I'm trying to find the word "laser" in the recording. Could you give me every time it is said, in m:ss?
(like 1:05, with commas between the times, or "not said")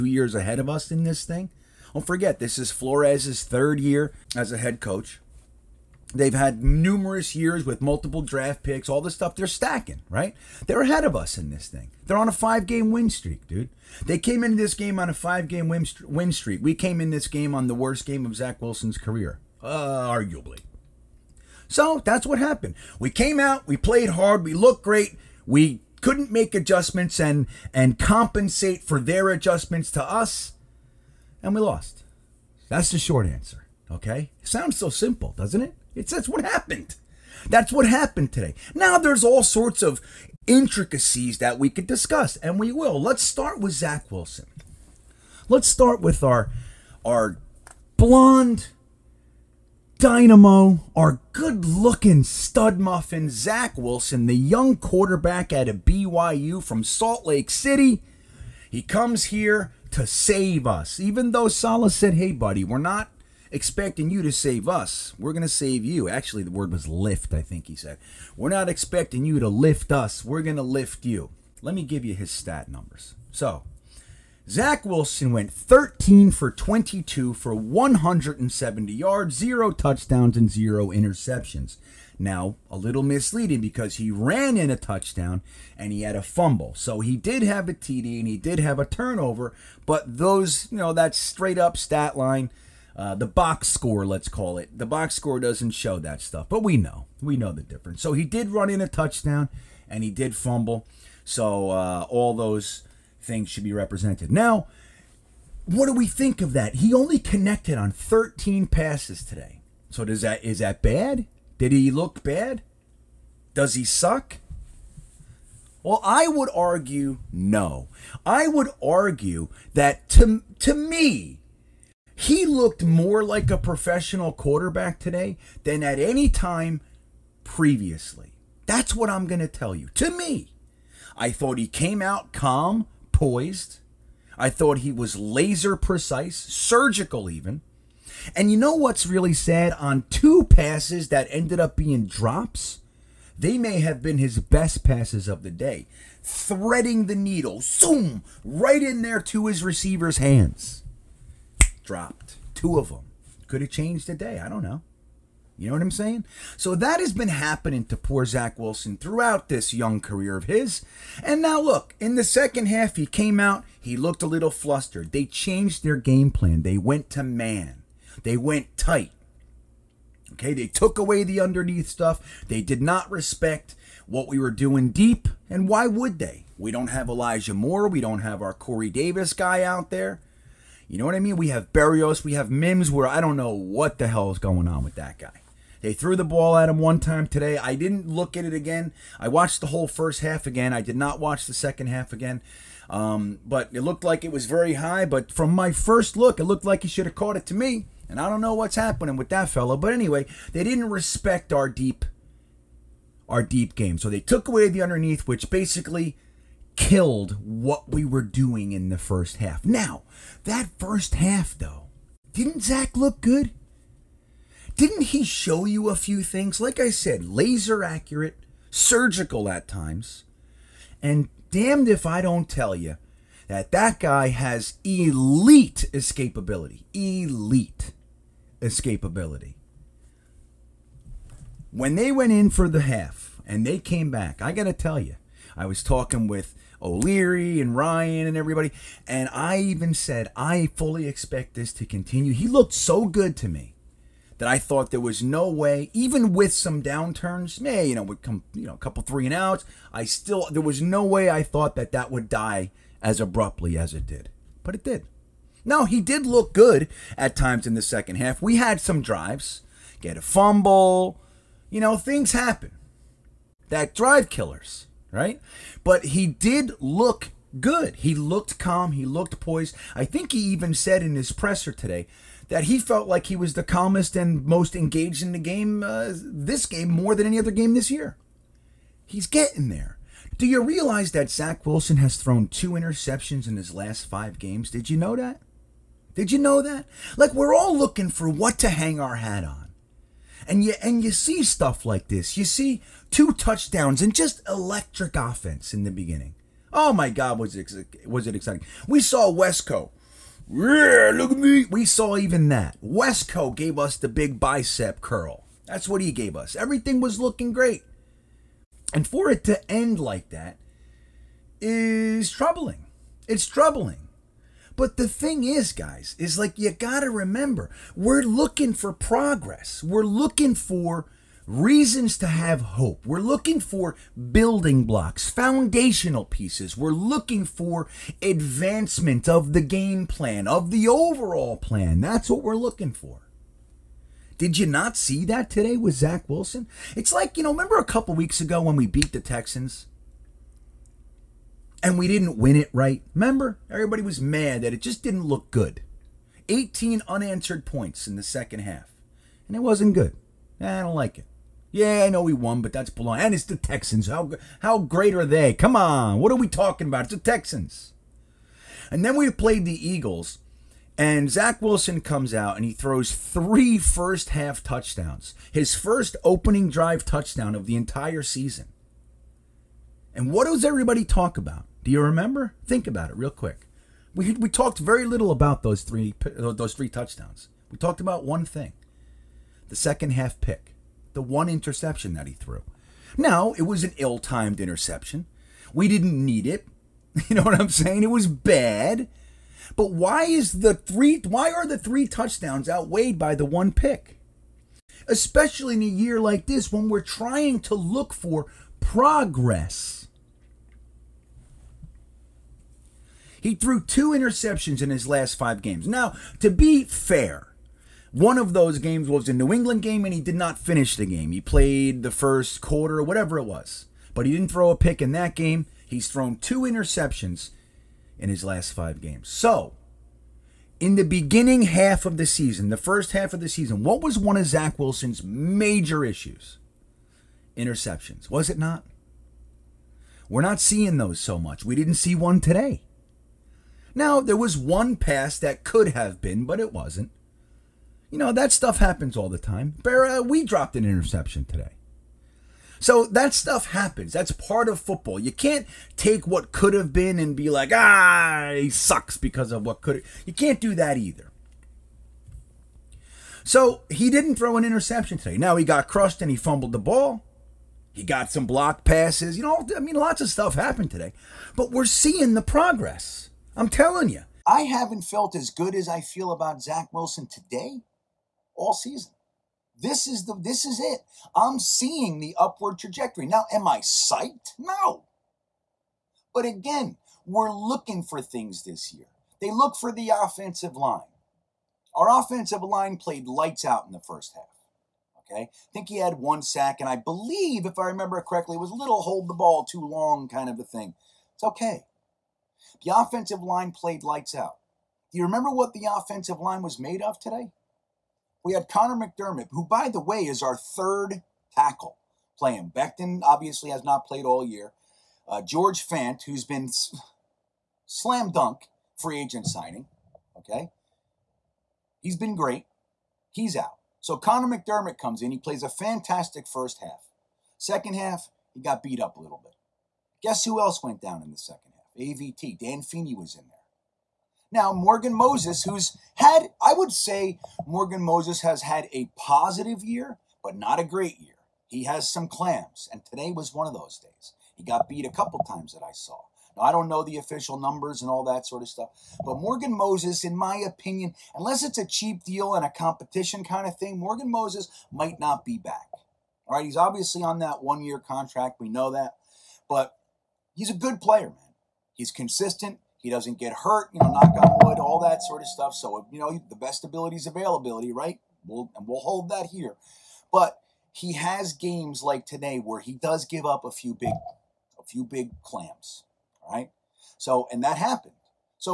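2:15, 3:37.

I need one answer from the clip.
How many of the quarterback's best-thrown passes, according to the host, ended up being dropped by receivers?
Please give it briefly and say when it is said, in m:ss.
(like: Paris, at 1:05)
2, at 2:32.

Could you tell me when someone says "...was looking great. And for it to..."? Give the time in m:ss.
5:07.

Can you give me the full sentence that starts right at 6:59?
So, in the beginning half of the season, the first half of the season, what was one of Zach Wilson's major issues?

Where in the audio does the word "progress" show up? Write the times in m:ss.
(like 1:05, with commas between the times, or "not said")
5:18, 6:38, 7:42.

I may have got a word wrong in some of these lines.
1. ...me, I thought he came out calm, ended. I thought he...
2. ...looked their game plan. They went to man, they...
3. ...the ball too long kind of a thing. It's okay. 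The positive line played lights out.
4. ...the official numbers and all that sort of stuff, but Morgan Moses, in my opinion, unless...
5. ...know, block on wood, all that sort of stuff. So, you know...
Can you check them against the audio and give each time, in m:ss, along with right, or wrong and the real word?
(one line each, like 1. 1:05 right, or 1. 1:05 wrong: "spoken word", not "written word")
1. 2:10 wrong: "poised", not "ended"
2. 2:45 wrong: "changed", not "looked"
3. 8:09 wrong: "offensive", not "positive"
4. 8:57 right
5. 9:14 wrong: "knock", not "block".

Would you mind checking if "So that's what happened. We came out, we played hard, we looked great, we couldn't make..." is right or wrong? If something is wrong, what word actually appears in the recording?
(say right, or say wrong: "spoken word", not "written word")
right.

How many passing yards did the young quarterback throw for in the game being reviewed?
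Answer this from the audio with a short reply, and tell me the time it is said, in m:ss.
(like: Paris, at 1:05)
170, at 1:17.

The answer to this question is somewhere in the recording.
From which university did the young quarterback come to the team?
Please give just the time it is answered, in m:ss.
0:55.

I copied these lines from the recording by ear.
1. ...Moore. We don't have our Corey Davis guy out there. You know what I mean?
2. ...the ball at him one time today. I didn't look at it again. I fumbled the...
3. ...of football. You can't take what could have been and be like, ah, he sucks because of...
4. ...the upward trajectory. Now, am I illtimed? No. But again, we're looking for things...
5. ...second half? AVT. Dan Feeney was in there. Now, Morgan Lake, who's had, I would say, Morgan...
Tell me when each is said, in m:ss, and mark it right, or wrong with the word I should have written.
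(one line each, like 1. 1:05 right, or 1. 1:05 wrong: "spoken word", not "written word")
1. 2:57 right
2. 3:06 wrong: "watched", not "fumbled"
3. 7:24 right
4. 7:52 wrong: "psyched", not "illtimed"
5. 8:41 wrong: "Moses", not "Lake".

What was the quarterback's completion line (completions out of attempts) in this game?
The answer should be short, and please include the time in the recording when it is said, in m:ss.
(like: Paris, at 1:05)
13 for 22, at 1:15.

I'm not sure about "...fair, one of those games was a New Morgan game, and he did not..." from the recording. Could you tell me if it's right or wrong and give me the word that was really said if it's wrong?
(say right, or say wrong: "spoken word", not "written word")
wrong: "England", not "Morgan".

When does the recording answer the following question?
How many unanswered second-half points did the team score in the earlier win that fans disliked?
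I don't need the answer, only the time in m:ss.
5:46.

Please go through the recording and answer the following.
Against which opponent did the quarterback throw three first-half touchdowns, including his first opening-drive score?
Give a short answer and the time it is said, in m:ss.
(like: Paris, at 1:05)
Eagles, at 5:59.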